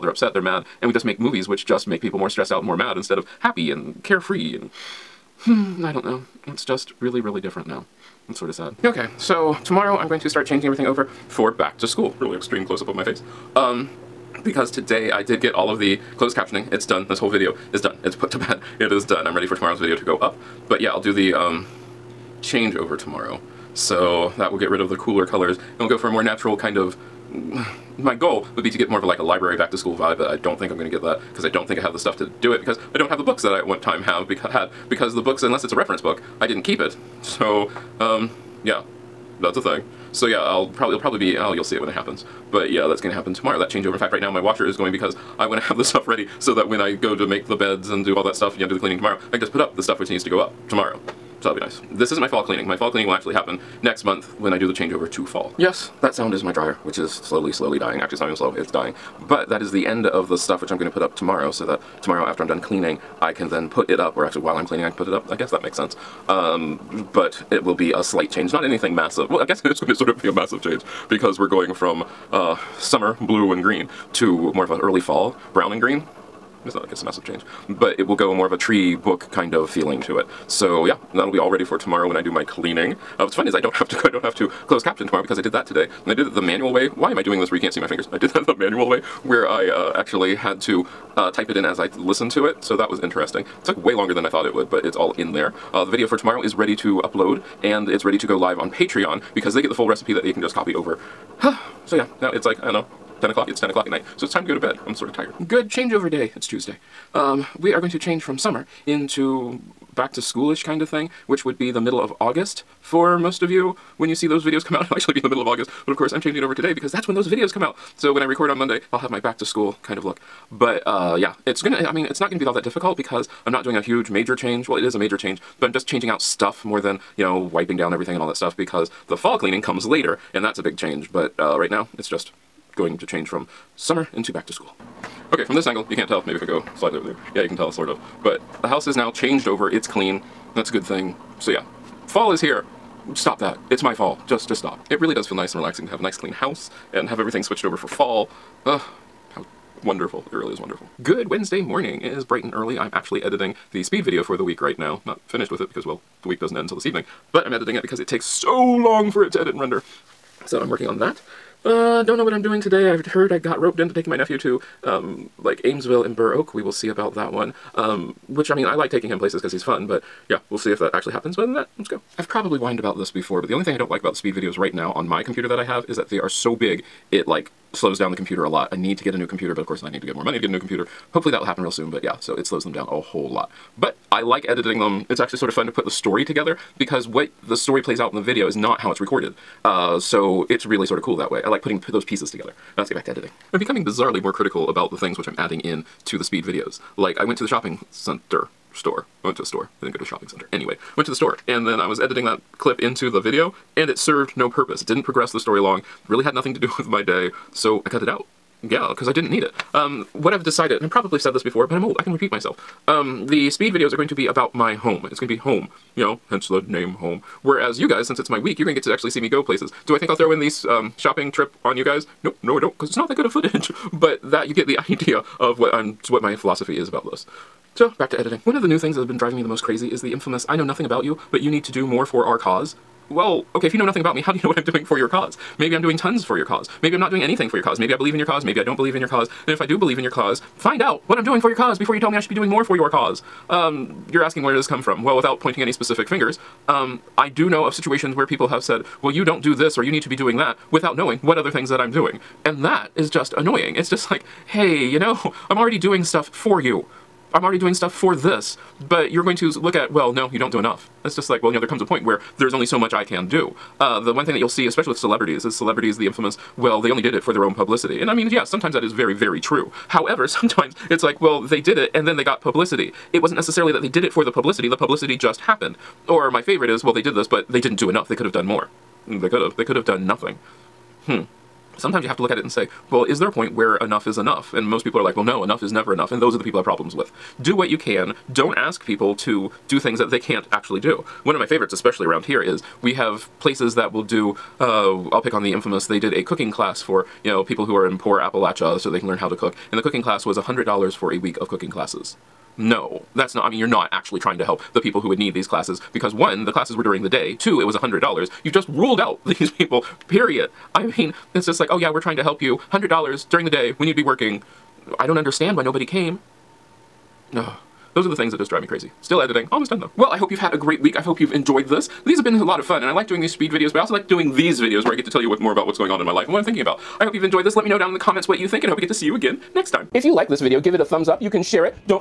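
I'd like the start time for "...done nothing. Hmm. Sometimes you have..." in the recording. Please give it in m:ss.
4:39.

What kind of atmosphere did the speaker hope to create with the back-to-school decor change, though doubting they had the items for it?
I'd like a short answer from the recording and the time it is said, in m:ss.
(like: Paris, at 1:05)
library back to school vibe, at 0:29.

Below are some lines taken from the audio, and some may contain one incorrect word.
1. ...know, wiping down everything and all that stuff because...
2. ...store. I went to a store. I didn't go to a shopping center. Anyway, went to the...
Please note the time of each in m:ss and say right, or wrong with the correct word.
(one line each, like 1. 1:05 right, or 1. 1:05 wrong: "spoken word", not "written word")
1. 2:07 right
2. 3:18 right.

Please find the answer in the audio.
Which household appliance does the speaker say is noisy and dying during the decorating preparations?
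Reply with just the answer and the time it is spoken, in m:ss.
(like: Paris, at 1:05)
dryer, at 0:56.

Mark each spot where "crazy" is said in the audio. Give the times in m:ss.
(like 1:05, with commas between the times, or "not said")
3:49, 5:18.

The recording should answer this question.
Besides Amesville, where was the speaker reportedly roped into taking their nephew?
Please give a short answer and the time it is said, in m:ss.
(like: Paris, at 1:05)
Burr Oak, at 2:46.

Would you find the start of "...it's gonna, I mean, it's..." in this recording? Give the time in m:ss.
2:01.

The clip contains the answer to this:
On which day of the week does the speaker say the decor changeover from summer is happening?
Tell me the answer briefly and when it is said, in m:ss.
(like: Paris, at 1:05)
Tuesday, at 1:46.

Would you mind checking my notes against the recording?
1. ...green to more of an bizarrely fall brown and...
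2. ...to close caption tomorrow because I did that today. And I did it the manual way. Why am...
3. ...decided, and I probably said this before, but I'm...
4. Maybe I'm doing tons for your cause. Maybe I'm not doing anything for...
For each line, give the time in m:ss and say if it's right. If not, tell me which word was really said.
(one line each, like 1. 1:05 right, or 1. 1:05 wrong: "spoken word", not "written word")
1. 1:13 wrong: "early", not "bizarrely"
2. 1:24 right
3. 3:30 right
4. 3:55 right.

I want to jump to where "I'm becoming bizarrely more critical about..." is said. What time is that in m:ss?
3:13.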